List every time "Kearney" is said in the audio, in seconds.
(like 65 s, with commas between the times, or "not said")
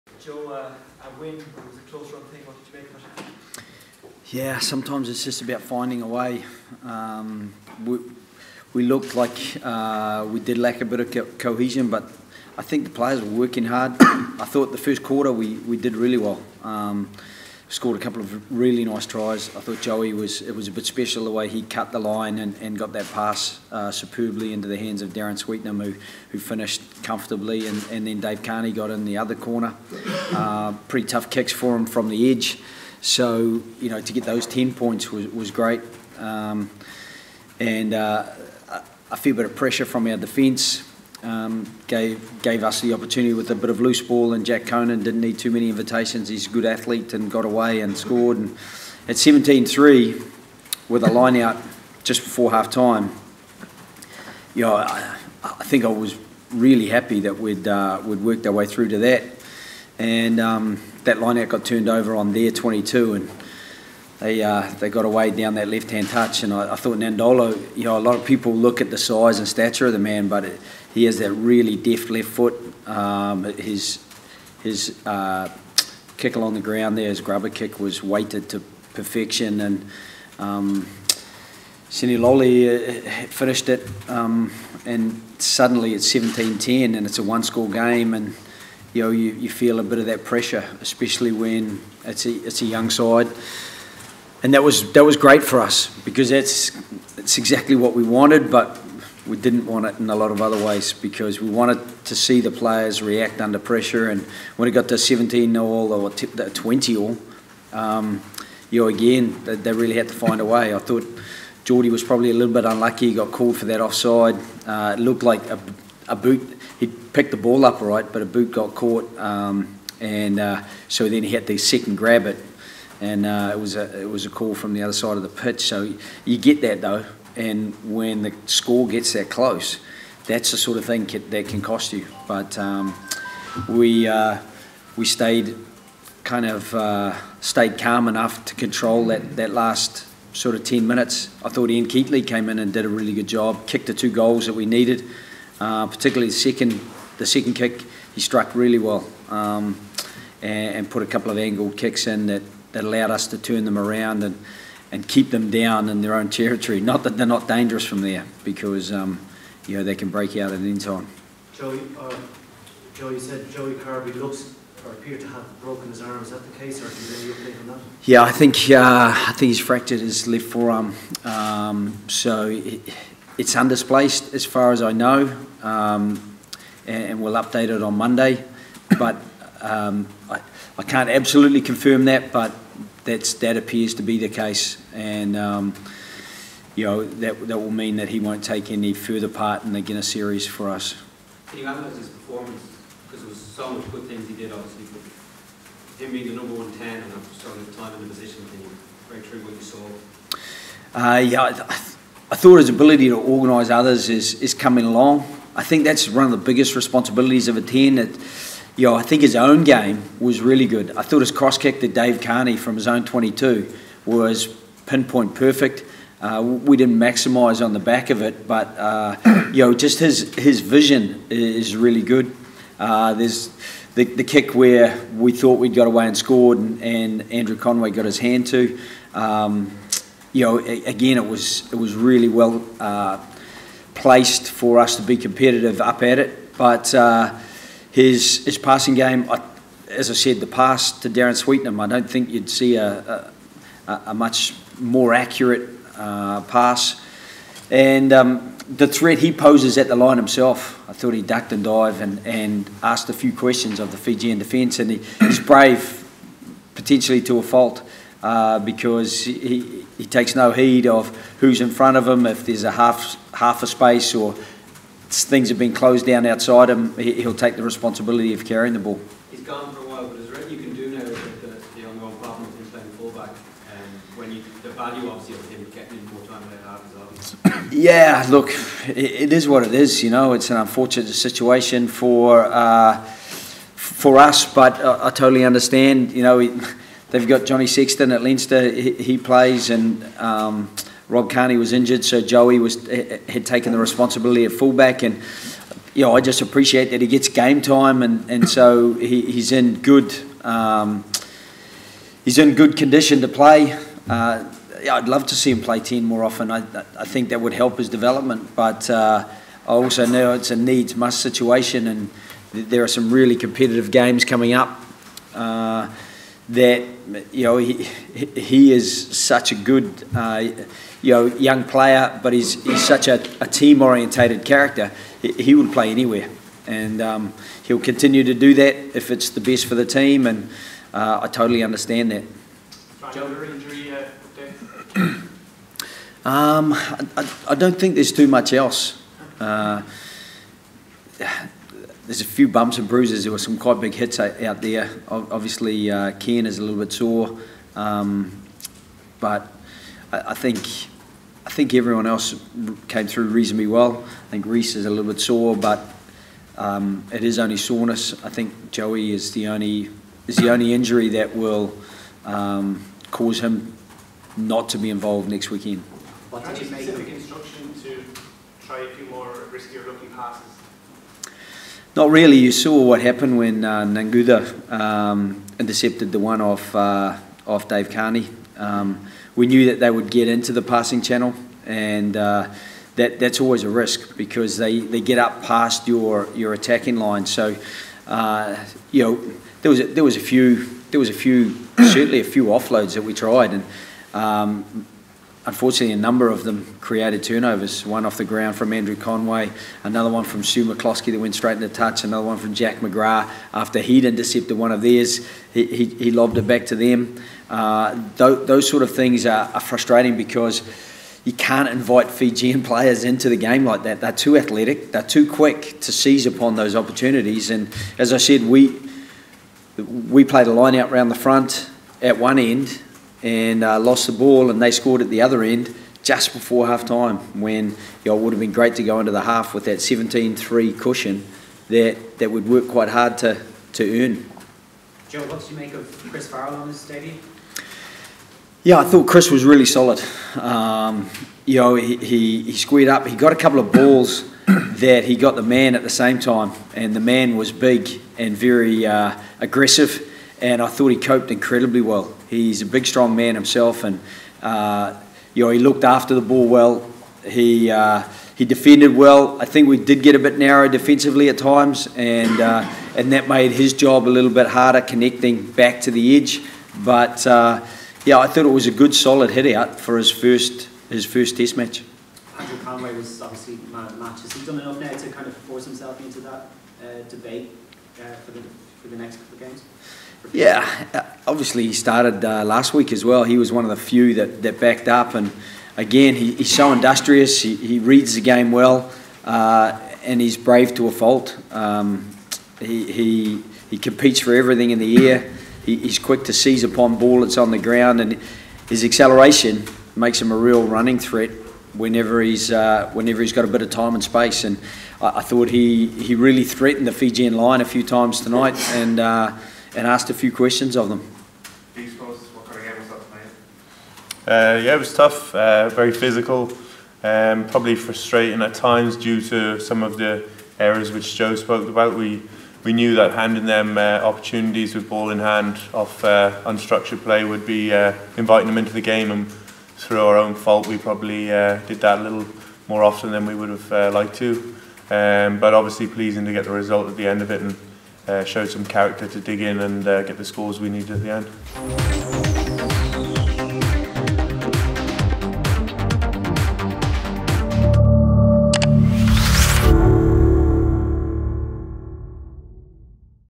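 28 s, 212 s, 291 s, 377 s.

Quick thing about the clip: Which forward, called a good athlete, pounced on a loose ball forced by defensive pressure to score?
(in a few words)
Jack Conan.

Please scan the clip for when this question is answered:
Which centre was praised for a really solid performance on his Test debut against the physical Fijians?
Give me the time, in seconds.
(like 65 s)
436 s.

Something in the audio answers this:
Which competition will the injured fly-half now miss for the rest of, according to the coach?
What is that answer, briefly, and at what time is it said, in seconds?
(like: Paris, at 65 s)
Guinness Series, at 189 s.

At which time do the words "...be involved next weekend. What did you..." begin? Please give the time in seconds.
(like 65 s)
364 s.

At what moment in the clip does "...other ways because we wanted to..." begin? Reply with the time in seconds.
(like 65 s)
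100 s.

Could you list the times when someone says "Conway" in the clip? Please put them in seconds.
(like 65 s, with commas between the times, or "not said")
227 s, 398 s, 472 s.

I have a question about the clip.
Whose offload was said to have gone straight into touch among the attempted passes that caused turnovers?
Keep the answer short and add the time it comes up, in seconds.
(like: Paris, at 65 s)
Stu McCloskey, at 400 s.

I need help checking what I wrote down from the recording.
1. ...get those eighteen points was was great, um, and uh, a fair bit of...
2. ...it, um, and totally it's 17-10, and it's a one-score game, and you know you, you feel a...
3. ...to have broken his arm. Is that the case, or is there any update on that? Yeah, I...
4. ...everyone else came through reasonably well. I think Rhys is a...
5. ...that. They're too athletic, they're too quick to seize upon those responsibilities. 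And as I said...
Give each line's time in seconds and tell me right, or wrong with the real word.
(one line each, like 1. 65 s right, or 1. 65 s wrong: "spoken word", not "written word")
1. 34 s wrong: "ten", not "eighteen"
2. 83 s wrong: "suddenly", not "totally"
3. 165 s right
4. 351 s right
5. 413 s wrong: "opportunities", not "responsibilities".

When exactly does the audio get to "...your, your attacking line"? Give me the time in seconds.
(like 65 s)
385 s.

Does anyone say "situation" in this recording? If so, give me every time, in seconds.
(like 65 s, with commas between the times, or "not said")
281 s, 311 s.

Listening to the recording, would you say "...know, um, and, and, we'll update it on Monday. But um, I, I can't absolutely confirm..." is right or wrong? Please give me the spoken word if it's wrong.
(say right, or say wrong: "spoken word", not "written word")
right.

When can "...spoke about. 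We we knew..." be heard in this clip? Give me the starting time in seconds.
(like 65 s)
521 s.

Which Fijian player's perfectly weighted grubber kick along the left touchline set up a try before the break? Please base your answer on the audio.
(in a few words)
Nadolo.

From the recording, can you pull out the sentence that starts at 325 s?
He, he, would play anywhere, and um, he'll continue to do that if it's the best for the team.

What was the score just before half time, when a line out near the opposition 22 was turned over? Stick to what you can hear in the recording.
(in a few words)
17-3.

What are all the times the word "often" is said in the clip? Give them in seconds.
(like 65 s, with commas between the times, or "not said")
306 s, 532 s.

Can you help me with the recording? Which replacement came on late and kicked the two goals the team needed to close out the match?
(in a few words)
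Ian Keatley.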